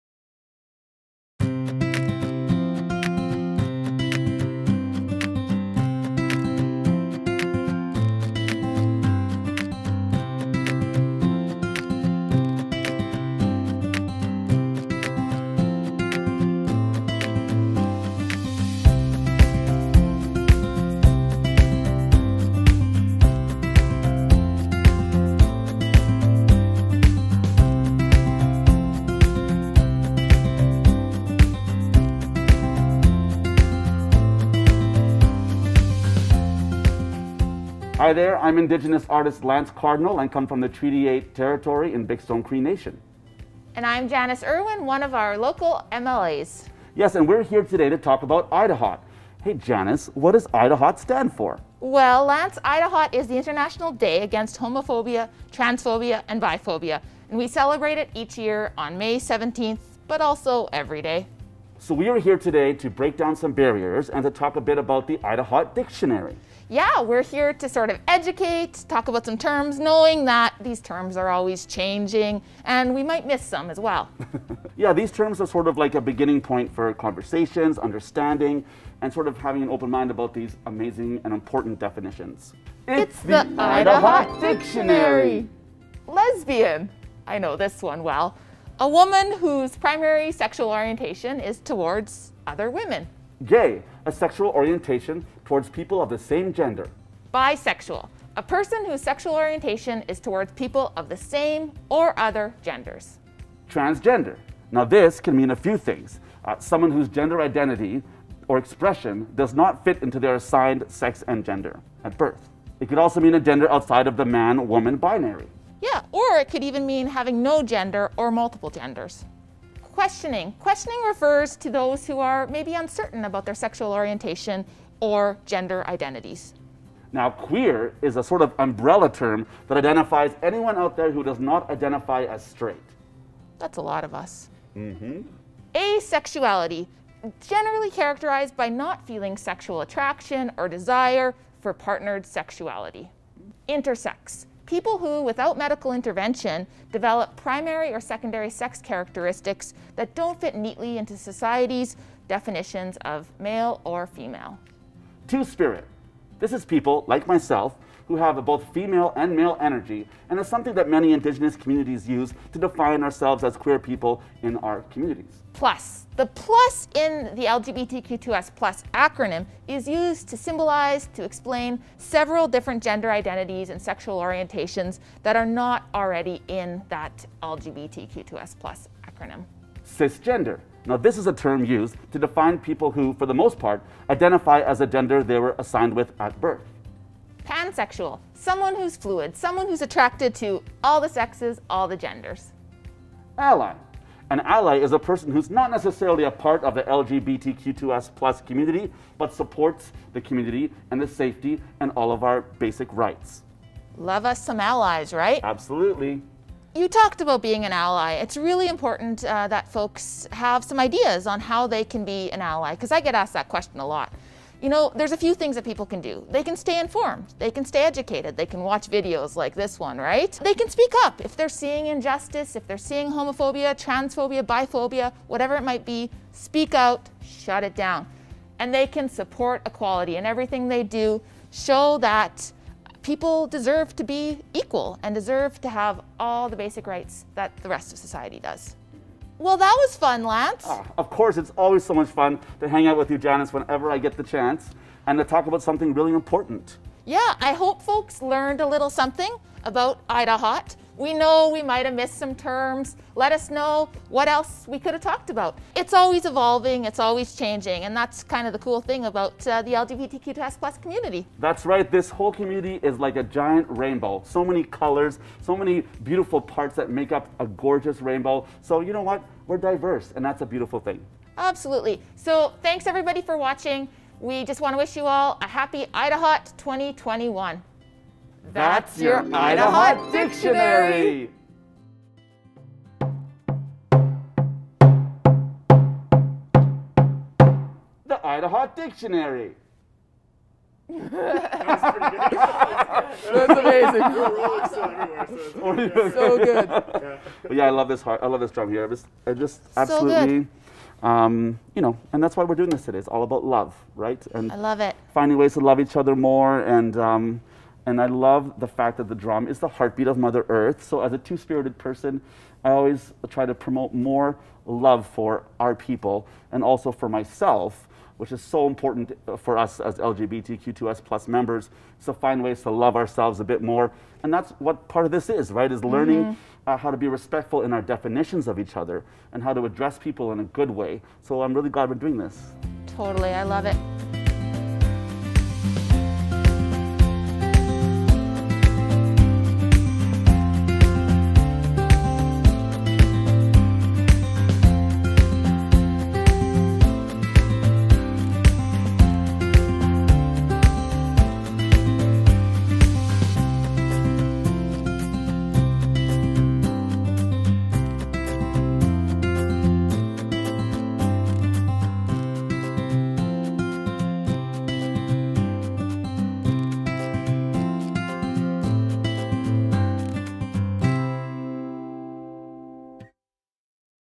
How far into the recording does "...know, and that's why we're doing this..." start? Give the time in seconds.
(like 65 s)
301 s.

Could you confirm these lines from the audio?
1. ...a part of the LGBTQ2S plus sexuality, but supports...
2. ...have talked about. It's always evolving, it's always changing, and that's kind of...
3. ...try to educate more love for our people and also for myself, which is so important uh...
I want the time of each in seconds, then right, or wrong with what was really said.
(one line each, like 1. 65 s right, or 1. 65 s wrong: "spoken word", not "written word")
1. 196 s wrong: "community", not "sexuality"
2. 254 s right
3. 313 s wrong: "promote", not "educate".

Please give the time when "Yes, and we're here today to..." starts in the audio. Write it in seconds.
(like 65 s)
46 s.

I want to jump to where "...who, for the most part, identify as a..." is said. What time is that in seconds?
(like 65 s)
182 s.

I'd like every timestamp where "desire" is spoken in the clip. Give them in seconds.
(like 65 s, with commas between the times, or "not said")
140 s.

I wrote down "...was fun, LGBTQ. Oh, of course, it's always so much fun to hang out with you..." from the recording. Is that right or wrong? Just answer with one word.
wrong.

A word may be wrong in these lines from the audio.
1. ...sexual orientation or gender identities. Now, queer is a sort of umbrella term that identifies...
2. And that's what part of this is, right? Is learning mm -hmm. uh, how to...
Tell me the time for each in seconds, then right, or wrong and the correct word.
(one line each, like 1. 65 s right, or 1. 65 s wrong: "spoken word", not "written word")
1. 123 s right
2. 324 s right.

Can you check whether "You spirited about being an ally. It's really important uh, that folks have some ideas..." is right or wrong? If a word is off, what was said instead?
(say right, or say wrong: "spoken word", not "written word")
wrong: "talked", not "spirited".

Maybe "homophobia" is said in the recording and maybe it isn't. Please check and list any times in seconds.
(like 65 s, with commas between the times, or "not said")
54 s, 223 s.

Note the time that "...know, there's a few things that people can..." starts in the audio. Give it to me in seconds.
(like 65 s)
214 s.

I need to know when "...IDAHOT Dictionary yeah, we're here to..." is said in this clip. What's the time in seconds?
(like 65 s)
65 s.